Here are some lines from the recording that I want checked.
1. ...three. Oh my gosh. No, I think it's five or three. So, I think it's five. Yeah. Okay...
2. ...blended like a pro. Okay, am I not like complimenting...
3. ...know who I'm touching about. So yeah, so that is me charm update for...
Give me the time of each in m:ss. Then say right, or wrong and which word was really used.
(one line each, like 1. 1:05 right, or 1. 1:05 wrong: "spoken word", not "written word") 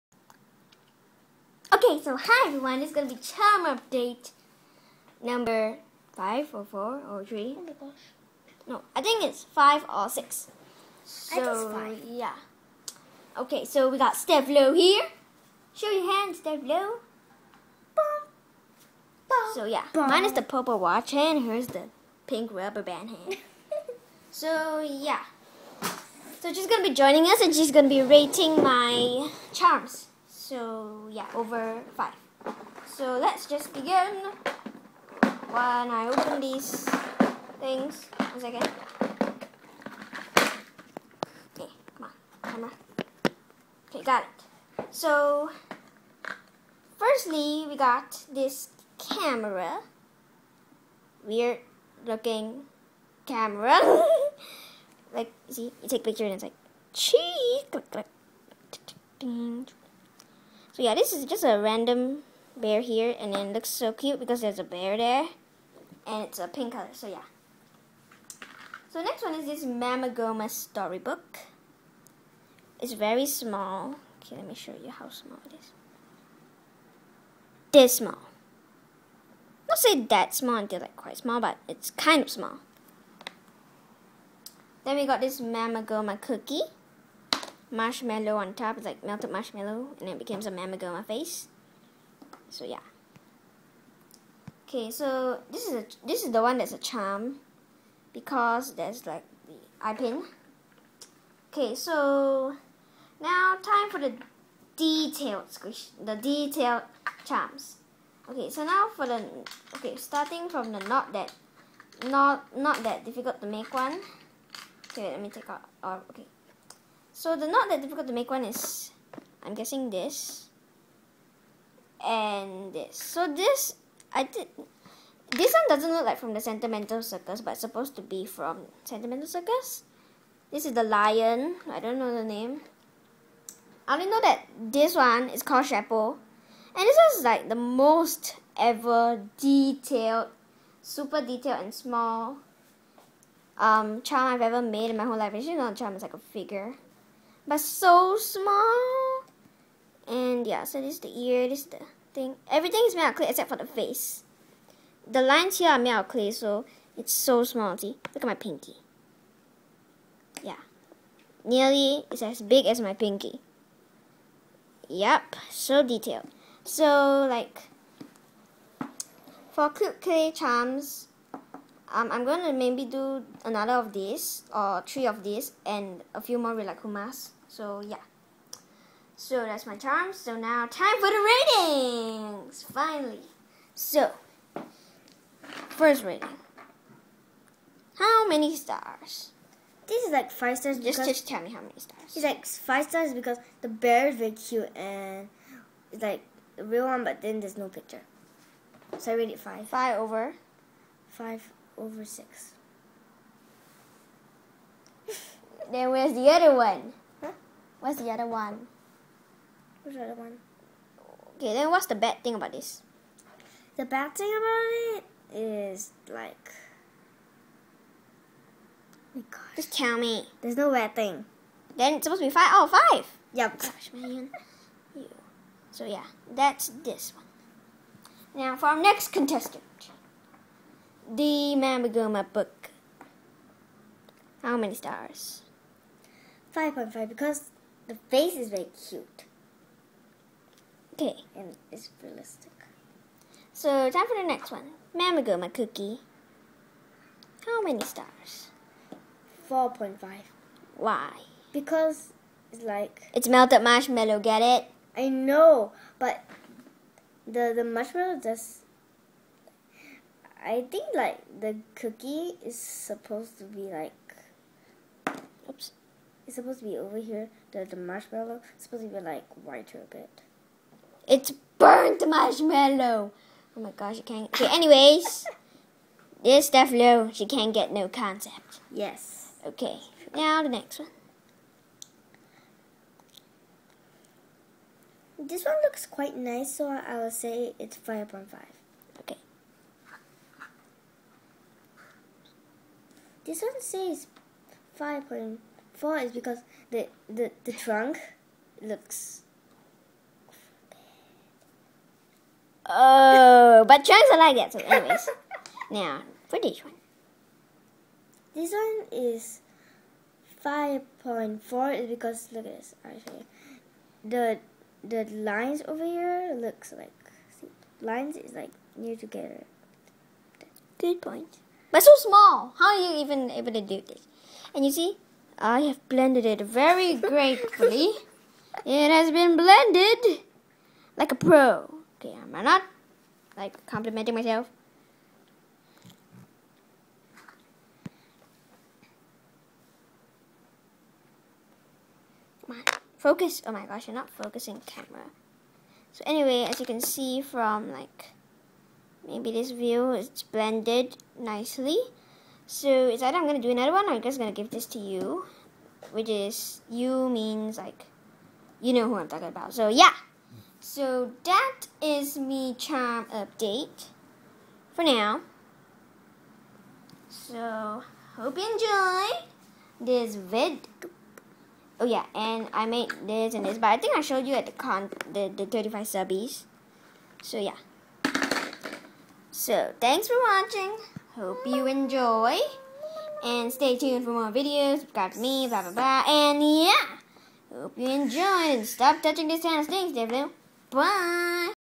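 1. 0:07 wrong: "six", not "three"
2. 5:29 right
3. 5:58 wrong: "talking", not "touching".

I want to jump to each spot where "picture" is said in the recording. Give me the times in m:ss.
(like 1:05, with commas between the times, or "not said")
0:56, 3:17.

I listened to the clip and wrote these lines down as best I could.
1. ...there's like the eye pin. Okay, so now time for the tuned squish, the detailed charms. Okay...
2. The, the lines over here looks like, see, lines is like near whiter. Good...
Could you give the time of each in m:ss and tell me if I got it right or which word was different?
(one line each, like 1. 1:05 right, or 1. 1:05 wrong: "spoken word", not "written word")
1. 1:38 wrong: "detailed", not "tuned"
2. 5:14 wrong: "together", not "whiter".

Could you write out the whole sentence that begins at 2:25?
It's not a charm, it's like a figure but so small.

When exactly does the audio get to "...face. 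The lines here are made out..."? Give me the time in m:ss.
2:33.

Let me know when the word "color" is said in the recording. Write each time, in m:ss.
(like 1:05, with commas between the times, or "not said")
1:06.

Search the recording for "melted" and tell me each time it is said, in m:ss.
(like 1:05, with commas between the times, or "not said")
1:29, 4:13.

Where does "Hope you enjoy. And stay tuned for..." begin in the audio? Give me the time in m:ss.
6:21.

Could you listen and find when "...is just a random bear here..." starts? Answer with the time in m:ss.
1:01.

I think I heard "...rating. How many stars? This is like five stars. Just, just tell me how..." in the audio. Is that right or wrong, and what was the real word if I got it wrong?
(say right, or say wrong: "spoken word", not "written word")
right.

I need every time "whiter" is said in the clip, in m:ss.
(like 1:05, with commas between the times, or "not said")
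4:29.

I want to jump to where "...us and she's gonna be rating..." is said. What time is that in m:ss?
0:27.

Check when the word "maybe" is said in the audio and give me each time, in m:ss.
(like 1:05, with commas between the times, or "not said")
2:52, 5:49.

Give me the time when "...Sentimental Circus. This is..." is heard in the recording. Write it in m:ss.
2:08.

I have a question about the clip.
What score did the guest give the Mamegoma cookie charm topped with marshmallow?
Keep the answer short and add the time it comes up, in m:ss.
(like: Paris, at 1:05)
4.5, at 4:09.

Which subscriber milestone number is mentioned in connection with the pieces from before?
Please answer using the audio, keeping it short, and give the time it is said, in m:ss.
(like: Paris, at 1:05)
35, at 6:15.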